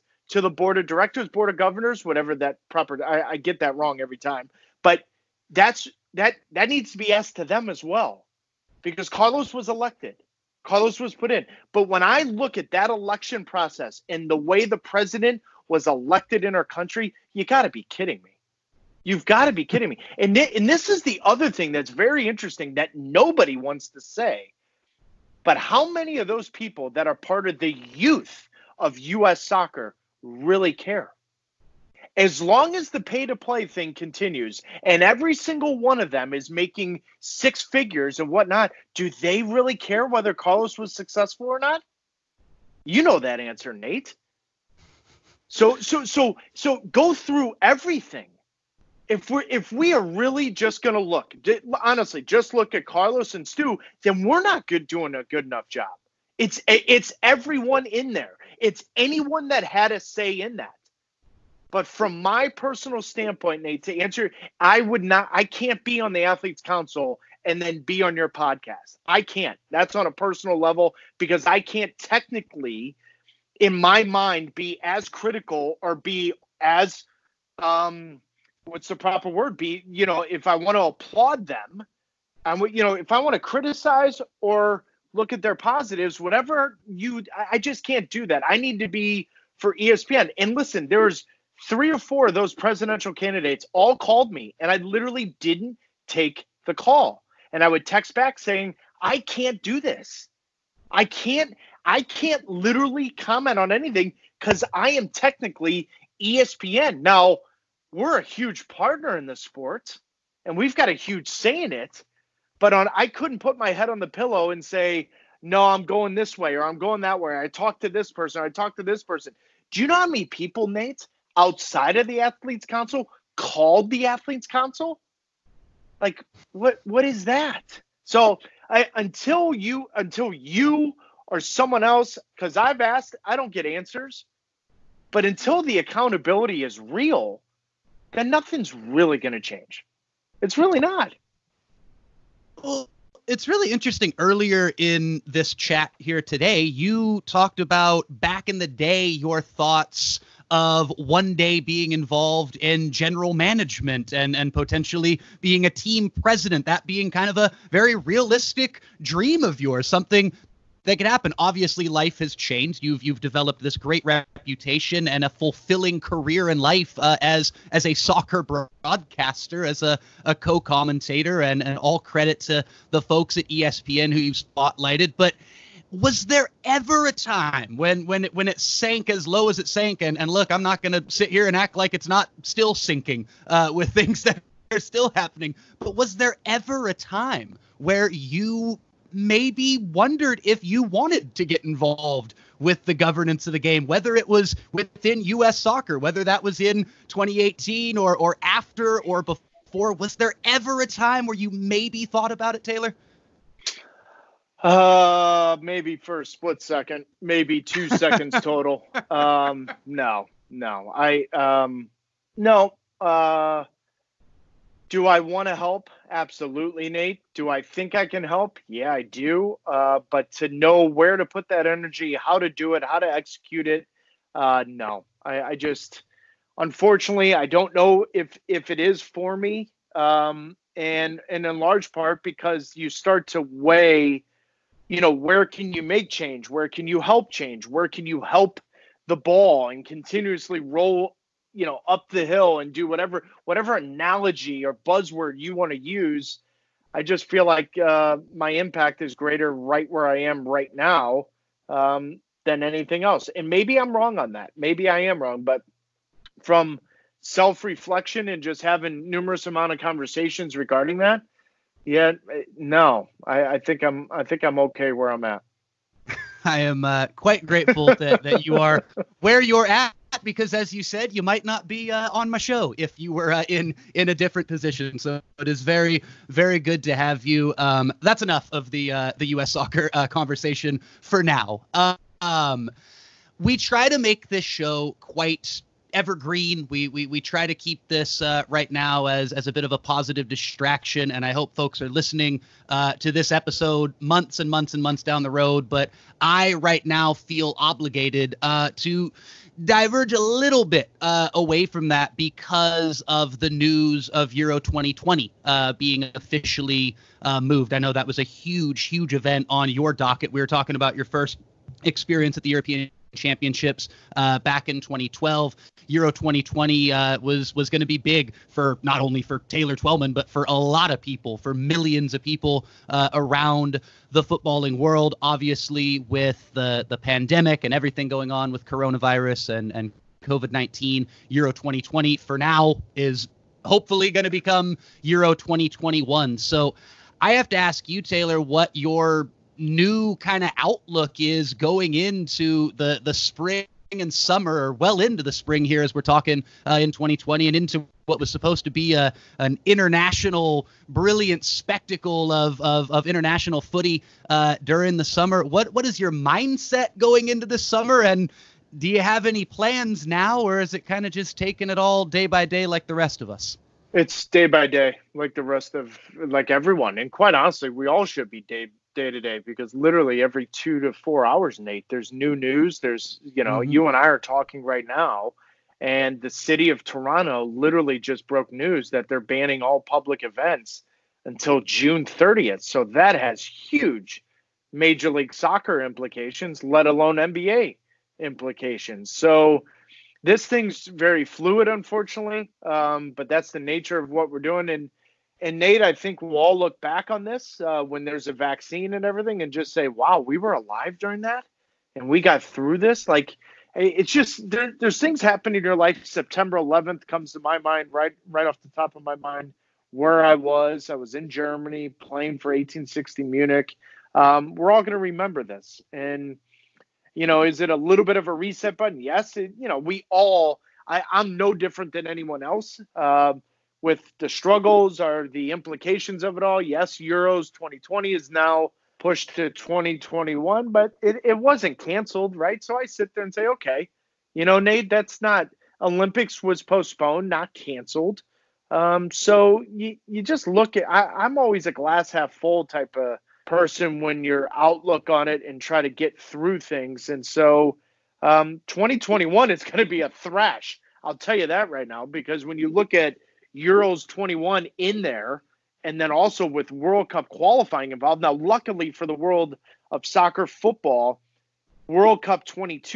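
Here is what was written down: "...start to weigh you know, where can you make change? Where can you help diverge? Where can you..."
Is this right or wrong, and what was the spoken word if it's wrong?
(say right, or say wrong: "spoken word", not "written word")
wrong: "change", not "diverge".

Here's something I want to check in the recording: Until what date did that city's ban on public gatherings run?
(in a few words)
June 30th.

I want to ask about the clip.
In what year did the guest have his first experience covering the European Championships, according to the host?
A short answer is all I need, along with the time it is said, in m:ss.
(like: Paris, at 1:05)
2012, at 5:14.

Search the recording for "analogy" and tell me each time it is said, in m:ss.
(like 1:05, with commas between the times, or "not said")
4:03.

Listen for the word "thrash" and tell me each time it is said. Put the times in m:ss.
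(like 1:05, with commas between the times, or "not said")
7:30.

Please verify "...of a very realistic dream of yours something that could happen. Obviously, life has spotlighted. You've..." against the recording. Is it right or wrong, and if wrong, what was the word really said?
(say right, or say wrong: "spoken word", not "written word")
wrong: "changed", not "spotlighted".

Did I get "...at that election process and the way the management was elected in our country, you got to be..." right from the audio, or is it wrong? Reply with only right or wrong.
wrong.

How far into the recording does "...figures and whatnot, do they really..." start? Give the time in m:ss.
0:37.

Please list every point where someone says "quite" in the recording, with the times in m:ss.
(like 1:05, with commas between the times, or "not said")
4:27, 4:45, 6:07.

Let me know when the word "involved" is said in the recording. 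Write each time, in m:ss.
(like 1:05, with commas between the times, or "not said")
2:31, 3:11, 7:37.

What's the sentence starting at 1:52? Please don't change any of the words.
But on I couldn't put my head on the pillow and say, no, I'm going this way or I'm going that way.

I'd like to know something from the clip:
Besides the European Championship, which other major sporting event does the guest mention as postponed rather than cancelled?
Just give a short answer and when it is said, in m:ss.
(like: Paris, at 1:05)
Olympics, at 7:15.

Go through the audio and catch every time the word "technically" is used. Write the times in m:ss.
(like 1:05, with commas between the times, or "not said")
1:11, 1:45.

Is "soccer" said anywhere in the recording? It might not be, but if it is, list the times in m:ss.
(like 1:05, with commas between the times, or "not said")
0:29, 2:47, 3:15, 4:39, 6:25, 7:40.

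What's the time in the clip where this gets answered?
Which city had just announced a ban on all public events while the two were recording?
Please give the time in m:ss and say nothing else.
6:16.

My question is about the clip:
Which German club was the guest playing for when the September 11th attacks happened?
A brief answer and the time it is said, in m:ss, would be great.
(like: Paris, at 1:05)
1860 Munich, at 6:52.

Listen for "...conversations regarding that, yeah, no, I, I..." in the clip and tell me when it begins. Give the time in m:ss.
4:19.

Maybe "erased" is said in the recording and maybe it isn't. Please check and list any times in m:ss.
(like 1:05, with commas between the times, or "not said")
not said.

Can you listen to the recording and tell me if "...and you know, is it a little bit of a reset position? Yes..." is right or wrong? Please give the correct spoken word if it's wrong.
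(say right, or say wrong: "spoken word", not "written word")
wrong: "button", not "position".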